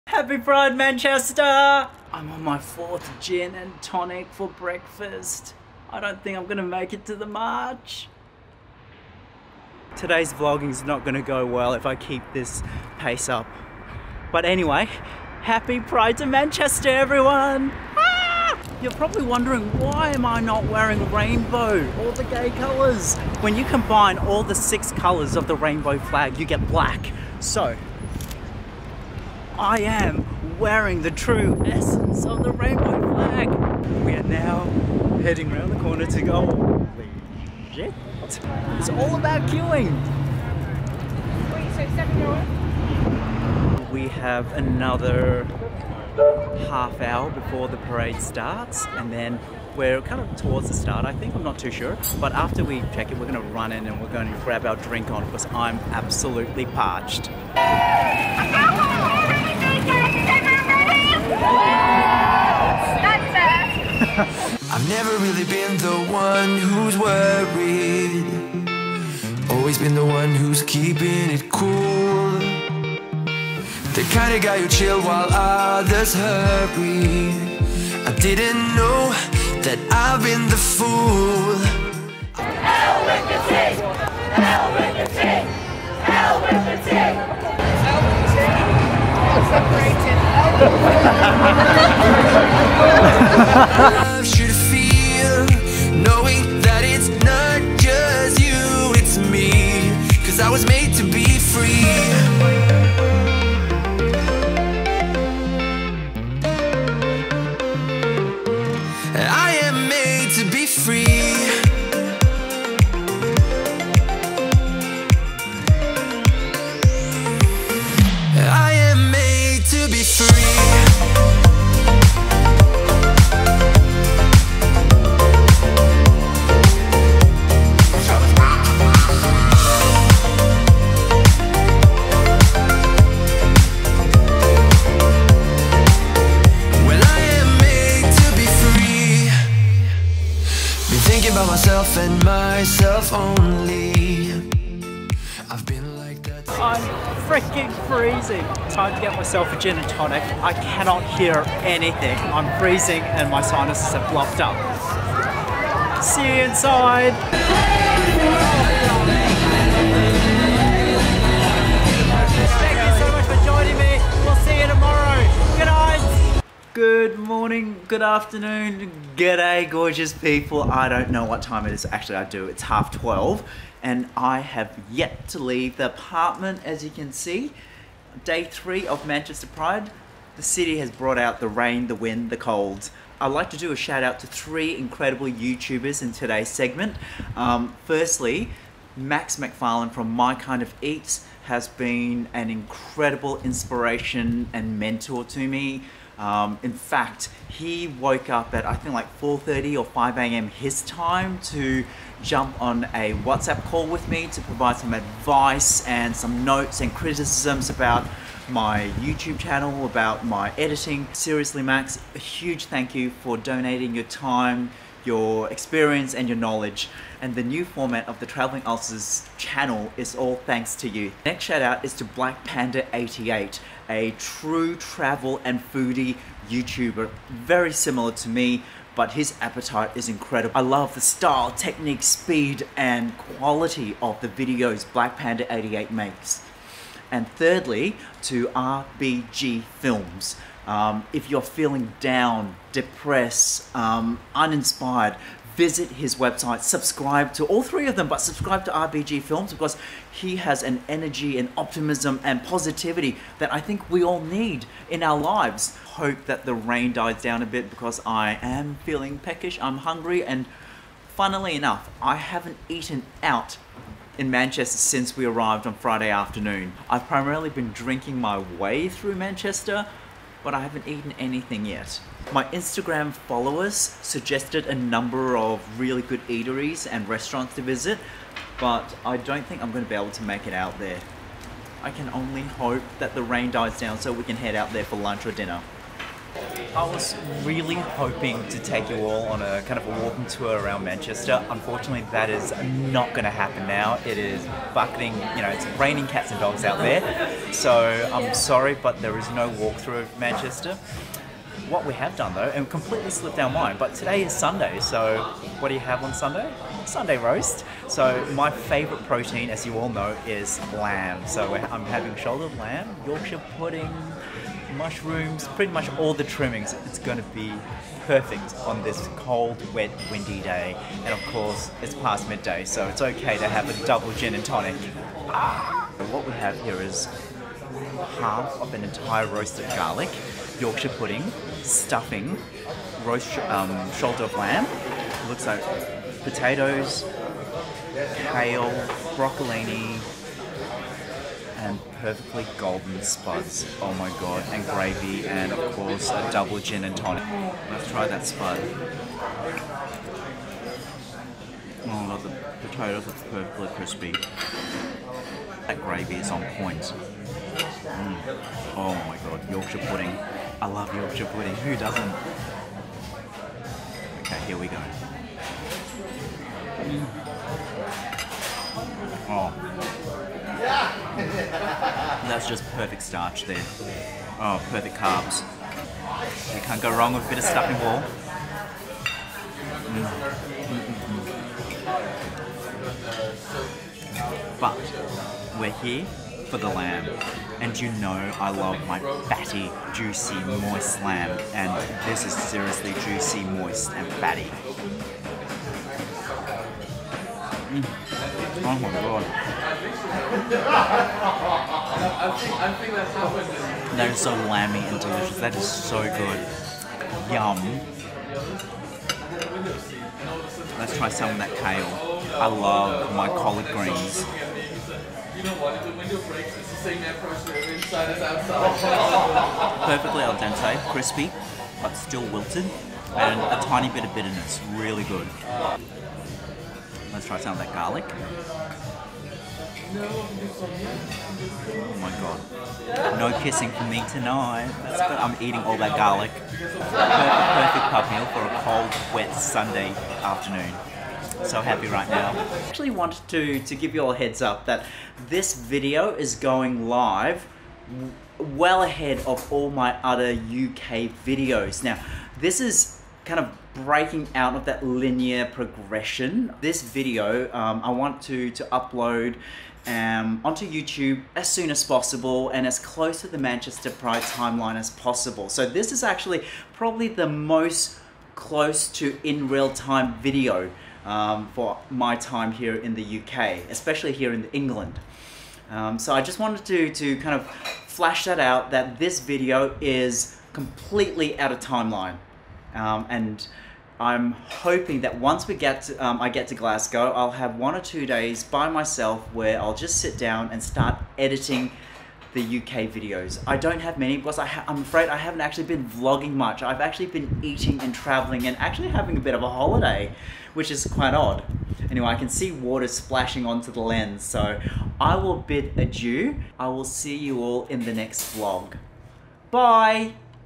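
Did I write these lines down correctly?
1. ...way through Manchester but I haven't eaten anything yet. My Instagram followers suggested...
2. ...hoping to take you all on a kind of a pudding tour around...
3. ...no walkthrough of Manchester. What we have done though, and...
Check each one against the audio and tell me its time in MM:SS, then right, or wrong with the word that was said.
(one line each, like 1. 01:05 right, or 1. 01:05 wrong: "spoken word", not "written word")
1. 04:28 right
2. 04:47 wrong: "walking", not "pudding"
3. 04:59 right.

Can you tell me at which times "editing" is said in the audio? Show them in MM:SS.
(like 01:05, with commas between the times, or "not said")
03:30, 08:11.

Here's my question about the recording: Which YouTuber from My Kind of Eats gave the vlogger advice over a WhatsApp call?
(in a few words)
Max McFarlin.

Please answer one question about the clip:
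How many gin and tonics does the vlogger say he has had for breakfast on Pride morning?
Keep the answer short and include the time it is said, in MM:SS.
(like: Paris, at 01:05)
4, at 00:02.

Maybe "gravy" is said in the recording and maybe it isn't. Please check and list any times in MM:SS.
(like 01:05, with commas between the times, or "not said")
05:44, 05:55.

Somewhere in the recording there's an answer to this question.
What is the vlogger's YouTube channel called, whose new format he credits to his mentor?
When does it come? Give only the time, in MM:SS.
03:38.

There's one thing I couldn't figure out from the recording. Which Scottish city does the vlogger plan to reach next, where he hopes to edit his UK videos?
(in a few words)
Glasgow.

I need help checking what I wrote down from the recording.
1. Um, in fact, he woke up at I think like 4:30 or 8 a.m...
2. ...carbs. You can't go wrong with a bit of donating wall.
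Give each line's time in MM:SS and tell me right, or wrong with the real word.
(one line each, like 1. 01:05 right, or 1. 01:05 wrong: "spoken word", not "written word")
1. 03:16 wrong: "5", not "8"
2. 06:14 wrong: "stuffing", not "donating".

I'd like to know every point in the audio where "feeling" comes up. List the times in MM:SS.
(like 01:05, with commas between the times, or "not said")
04:01, 04:18.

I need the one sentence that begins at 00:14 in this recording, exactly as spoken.
But anyway, happy Pride to Manchester, everyone!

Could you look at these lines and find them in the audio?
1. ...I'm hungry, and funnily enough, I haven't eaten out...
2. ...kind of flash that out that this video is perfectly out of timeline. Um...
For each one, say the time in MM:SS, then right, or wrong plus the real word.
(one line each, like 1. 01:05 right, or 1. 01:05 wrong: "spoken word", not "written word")
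1. 04:19 right
2. 07:57 wrong: "completely", not "perfectly".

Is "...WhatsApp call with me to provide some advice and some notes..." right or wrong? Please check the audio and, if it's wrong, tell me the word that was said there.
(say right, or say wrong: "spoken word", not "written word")
right.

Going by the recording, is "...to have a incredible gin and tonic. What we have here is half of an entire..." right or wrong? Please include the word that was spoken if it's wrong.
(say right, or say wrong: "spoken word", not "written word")
wrong: "double", not "incredible".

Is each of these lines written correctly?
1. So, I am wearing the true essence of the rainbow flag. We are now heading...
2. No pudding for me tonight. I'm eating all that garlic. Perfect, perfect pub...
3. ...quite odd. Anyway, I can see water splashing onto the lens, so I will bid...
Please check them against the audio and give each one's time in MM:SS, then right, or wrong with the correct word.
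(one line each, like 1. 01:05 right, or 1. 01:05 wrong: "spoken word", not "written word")
1. 00:27 right
2. 07:13 wrong: "kissing", not "pudding"
3. 08:20 right.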